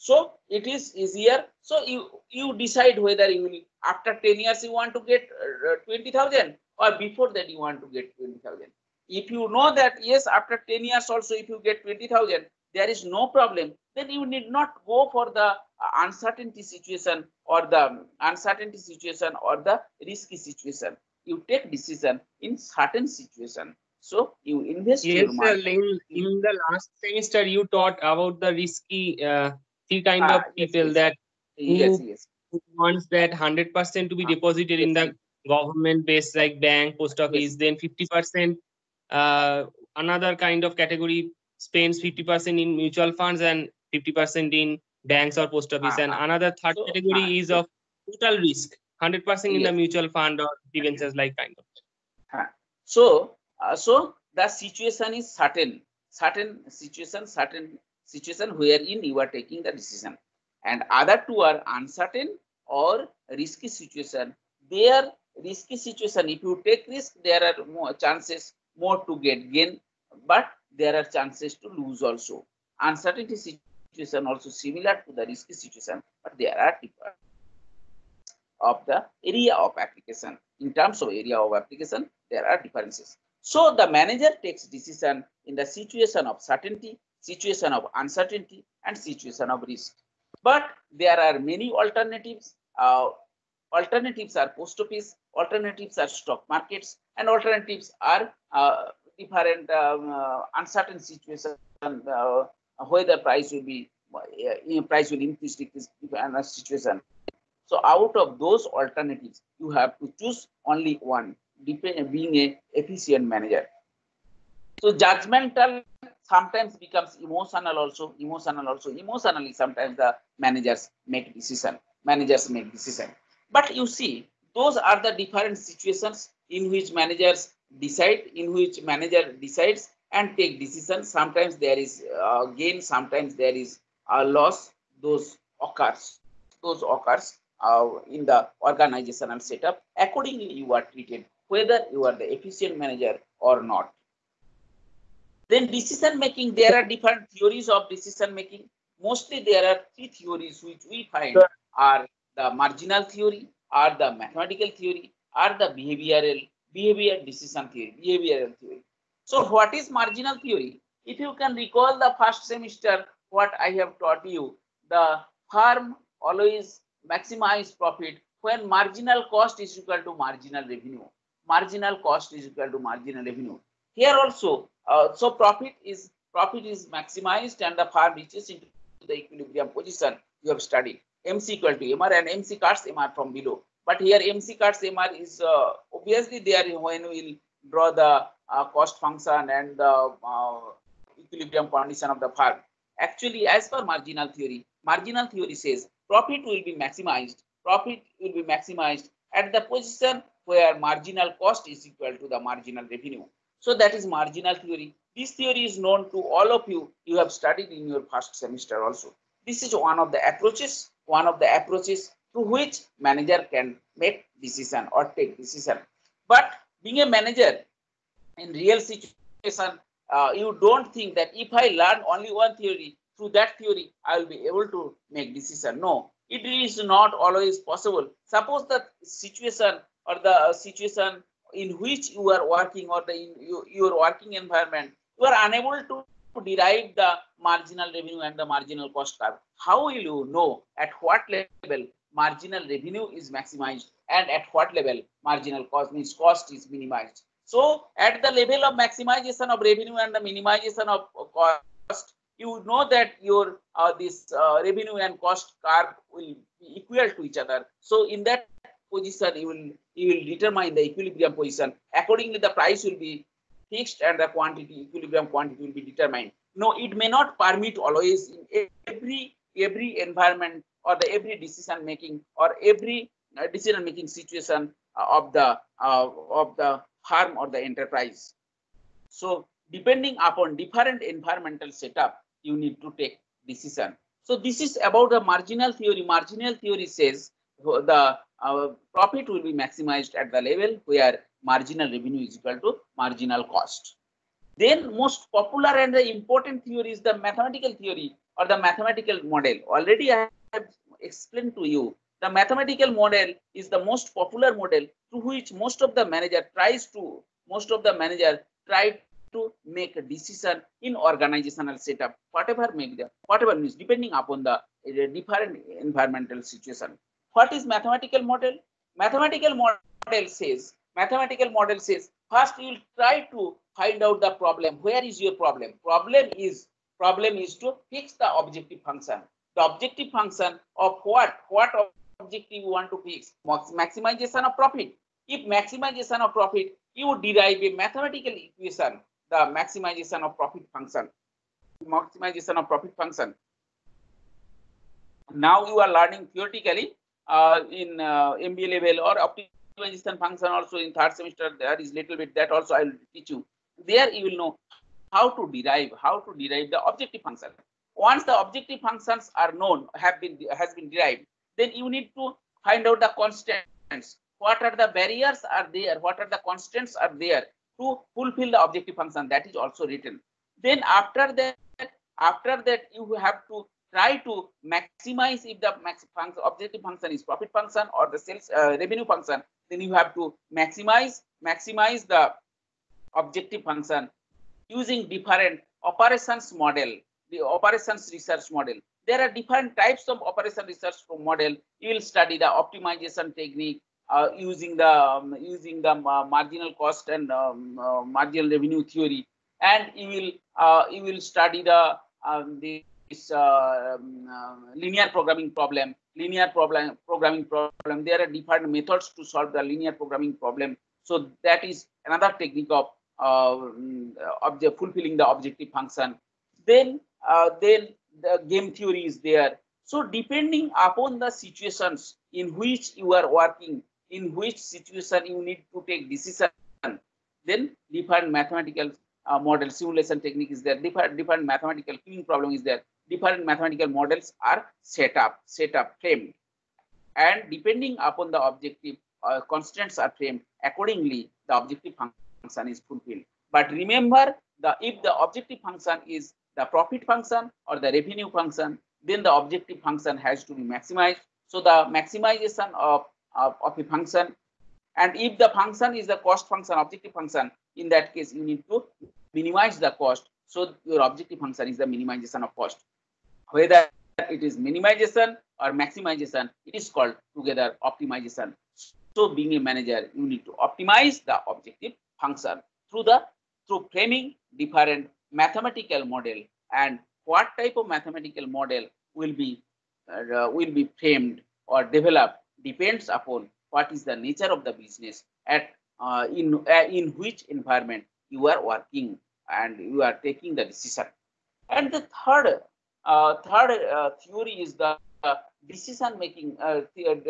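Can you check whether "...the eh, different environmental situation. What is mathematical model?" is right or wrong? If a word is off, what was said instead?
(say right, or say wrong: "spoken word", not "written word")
right.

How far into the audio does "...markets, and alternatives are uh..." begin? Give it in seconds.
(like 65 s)
96 s.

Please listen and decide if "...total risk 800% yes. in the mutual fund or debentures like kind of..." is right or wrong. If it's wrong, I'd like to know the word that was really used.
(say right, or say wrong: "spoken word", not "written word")
wrong: "100", not "800".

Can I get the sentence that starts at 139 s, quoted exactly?
Accordingly, you are treated whether you are the efficient manager or not.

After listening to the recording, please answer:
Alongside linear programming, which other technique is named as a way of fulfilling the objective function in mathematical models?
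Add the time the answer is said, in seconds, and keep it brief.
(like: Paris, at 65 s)
game theory, at 418 s.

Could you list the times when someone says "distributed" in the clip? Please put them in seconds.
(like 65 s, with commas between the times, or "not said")
not said.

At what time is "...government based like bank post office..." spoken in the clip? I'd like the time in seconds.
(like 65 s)
35 s.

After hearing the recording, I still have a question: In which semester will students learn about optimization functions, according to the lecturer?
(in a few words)
third semester.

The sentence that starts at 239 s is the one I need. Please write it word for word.
How will you know at what level marginal revenue is maximized and at what level marginal cost means cost is minimized.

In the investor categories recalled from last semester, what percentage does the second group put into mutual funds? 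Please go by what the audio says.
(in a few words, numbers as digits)
50%.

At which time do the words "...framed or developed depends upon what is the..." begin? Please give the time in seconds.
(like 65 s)
481 s.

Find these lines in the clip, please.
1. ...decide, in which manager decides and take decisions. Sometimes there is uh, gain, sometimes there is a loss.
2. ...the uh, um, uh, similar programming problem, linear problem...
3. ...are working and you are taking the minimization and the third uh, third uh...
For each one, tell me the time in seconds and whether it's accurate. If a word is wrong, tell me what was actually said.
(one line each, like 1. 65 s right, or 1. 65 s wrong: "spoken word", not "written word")
1. 127 s right
2. 402 s wrong: "linear", not "similar"
3. 488 s wrong: "decision", not "minimization".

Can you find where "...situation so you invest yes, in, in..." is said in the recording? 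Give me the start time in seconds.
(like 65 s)
23 s.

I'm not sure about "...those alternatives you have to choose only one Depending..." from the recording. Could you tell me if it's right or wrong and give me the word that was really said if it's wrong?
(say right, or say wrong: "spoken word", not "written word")
right.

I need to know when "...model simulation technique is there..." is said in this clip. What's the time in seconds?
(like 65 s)
429 s.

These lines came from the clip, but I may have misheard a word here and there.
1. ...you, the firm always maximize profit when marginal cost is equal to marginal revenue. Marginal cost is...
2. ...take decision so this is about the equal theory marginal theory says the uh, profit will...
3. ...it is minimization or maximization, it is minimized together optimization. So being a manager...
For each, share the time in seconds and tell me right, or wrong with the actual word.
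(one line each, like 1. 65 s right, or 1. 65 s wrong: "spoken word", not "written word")
1. 164 s right
2. 282 s wrong: "marginal", not "equal"
3. 464 s wrong: "called", not "minimized".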